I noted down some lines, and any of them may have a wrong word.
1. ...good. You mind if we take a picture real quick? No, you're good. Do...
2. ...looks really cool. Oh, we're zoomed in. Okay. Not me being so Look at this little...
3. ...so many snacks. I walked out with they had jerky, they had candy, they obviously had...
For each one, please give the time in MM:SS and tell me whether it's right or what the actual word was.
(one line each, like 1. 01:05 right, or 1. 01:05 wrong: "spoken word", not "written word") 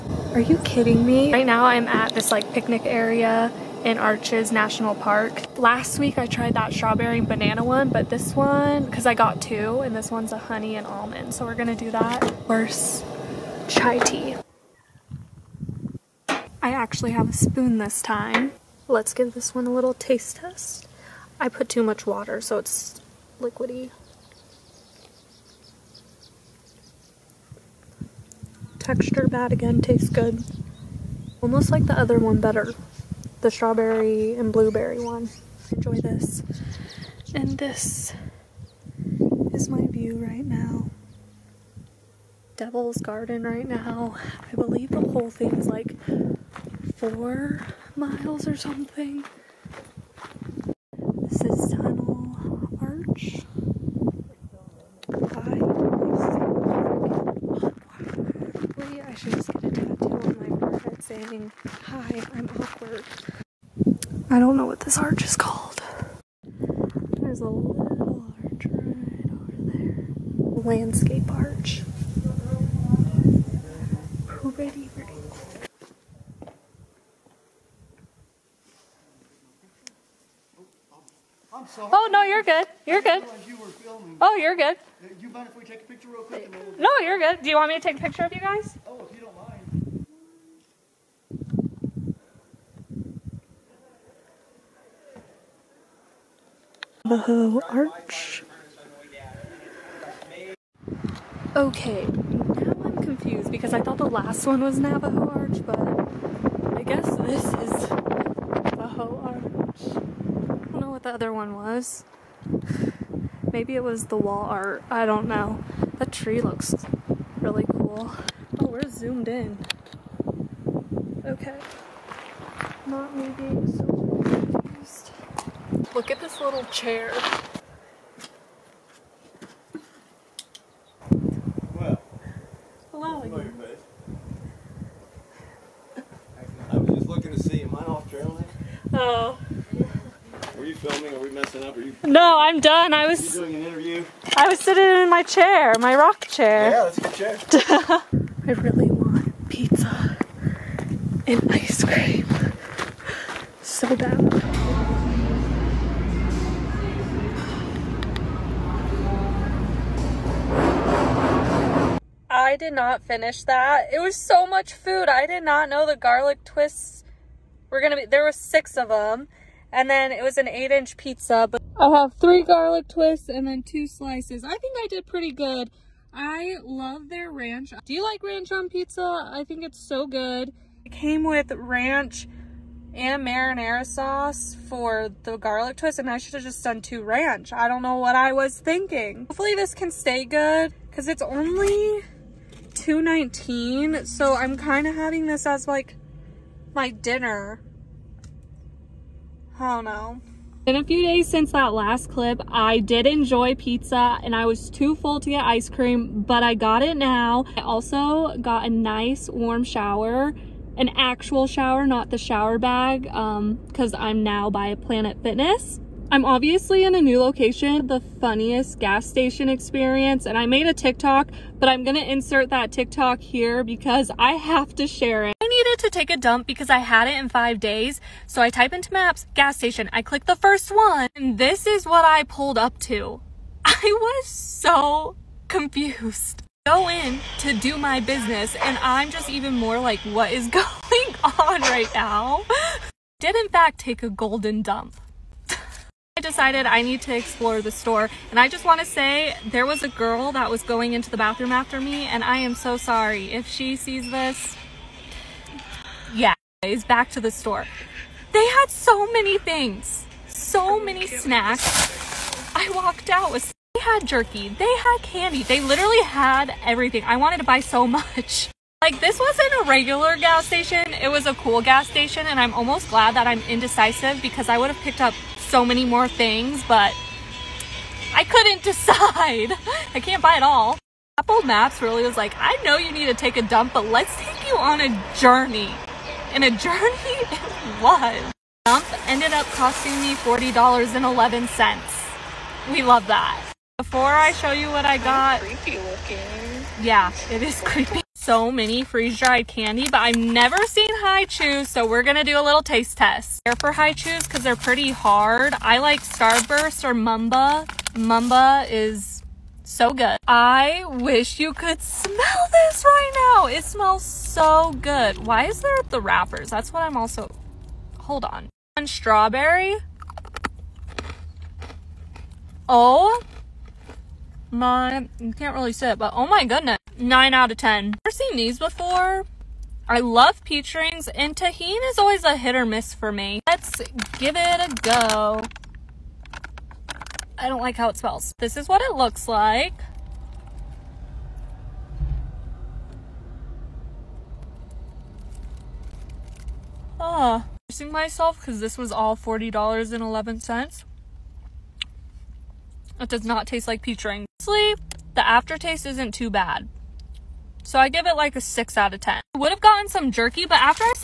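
1. 01:24 right
2. 01:56 right
3. 04:20 wrong: "literally", not "obviously".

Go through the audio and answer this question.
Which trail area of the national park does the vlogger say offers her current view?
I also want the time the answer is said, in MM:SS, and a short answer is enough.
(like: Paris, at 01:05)
Devil's Garden, at 00:42.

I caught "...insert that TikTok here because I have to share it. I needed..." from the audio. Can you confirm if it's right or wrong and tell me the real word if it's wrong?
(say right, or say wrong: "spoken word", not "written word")
right.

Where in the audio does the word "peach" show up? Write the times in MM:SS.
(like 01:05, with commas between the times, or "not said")
05:30, 05:53.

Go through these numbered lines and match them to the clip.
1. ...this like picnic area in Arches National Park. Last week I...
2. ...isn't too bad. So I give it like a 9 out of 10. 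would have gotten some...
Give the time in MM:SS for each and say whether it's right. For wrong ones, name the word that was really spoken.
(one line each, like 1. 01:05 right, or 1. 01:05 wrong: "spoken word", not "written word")
1. 00:02 right
2. 05:55 wrong: "6", not "9".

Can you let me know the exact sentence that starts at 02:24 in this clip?
I was sitting in my chair, my rock chair.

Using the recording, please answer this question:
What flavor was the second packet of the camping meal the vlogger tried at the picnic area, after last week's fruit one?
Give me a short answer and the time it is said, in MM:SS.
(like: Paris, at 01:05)
Honey and almond, at 00:10.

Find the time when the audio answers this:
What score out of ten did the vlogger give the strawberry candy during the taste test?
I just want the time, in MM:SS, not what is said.
05:26.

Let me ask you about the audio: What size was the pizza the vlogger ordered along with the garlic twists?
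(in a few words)
8 inch.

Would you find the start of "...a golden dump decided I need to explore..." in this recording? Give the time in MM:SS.
04:04.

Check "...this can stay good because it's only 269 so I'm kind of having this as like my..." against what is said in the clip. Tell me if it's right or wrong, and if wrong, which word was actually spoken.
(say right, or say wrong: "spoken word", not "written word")
wrong: "219", not "269".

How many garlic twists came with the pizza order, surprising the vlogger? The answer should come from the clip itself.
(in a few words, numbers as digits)
6.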